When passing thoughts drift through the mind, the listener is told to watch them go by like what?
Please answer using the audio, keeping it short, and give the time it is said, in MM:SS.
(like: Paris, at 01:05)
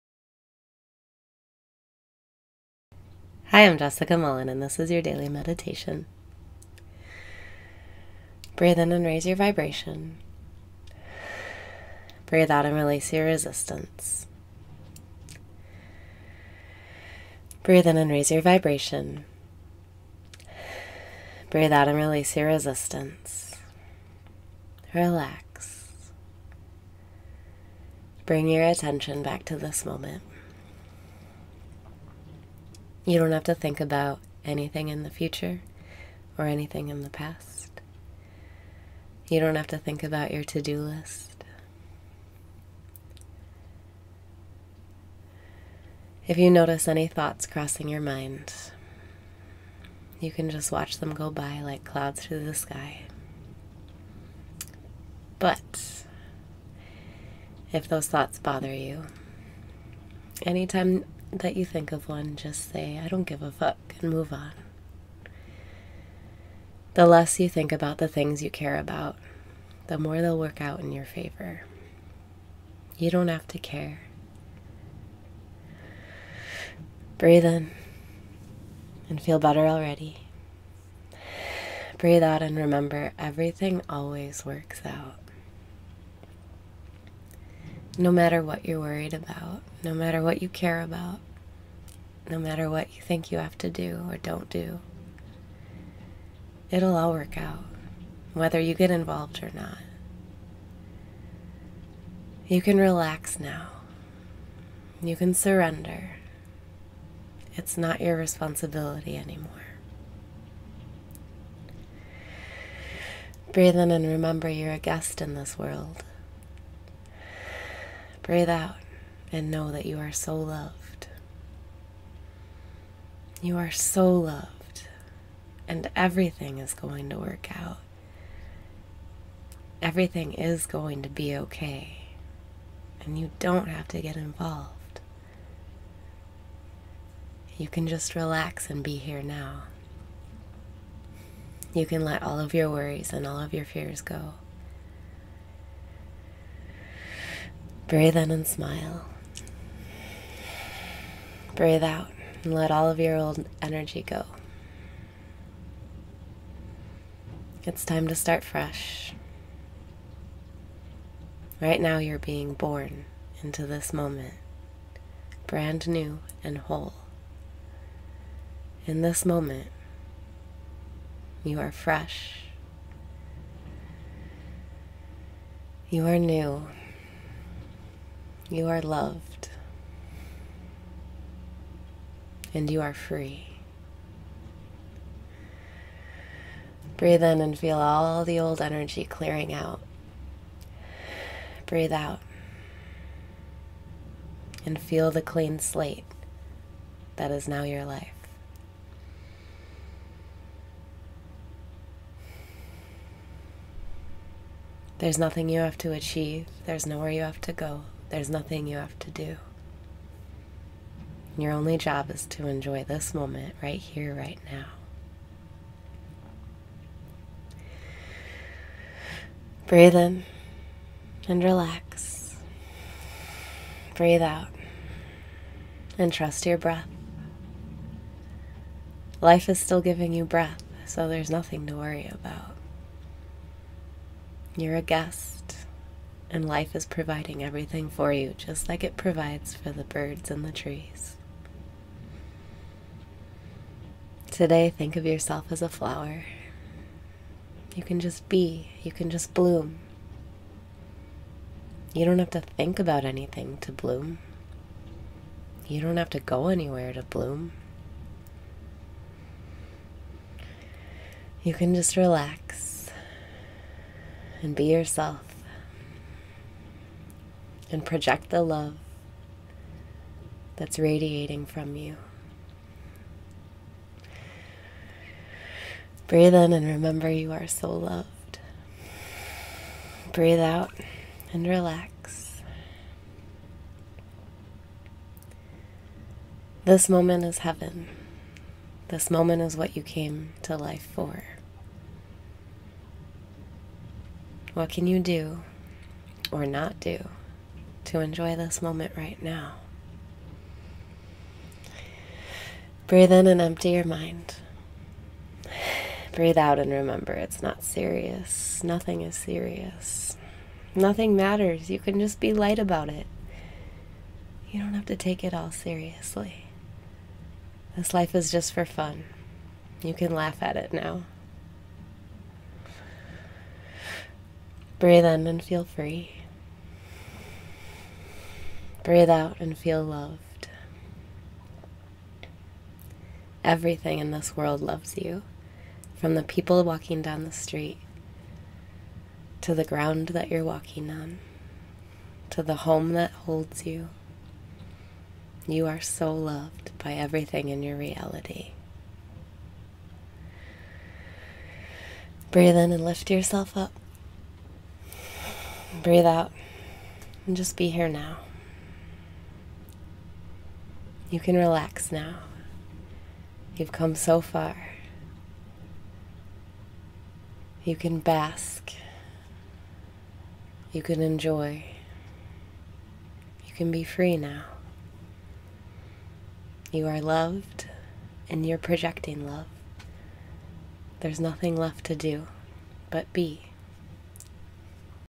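clouds through the sky, at 00:51.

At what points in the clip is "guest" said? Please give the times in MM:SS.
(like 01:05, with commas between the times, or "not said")
01:54, 03:54.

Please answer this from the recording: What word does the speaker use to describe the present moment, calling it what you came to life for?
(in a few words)
heaven.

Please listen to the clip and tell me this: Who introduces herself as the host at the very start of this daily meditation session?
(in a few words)
Jessica Mullen.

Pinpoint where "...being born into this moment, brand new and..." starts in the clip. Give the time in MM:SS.
02:42.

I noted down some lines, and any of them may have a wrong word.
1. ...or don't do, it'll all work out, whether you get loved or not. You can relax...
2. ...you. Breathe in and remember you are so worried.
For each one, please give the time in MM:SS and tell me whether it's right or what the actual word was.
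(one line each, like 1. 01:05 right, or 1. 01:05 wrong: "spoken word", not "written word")
1. 01:34 wrong: "involved", not "loved"
2. 04:31 wrong: "loved", not "worried".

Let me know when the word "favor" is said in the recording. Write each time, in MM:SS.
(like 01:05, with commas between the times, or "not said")
01:11.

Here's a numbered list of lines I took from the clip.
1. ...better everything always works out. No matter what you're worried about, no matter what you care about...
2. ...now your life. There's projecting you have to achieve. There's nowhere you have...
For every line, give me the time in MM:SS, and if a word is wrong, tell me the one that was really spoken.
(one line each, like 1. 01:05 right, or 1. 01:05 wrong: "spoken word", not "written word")
1. 01:22 wrong: "remember", not "better"
2. 03:17 wrong: "nothing", not "projecting".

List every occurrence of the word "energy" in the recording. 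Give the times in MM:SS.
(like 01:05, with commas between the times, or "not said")
02:33, 03:08.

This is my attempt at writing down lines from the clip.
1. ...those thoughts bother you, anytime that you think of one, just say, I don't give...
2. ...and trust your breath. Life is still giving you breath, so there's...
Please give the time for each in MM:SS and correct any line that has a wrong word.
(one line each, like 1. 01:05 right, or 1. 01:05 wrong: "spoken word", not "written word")
1. 00:57 right
2. 03:45 right.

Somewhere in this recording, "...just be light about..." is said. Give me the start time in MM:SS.
05:11.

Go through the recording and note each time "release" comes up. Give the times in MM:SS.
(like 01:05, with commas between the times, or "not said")
00:12, 00:21.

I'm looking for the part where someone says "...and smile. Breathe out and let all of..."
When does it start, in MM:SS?
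02:28.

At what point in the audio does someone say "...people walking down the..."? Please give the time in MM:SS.
05:36.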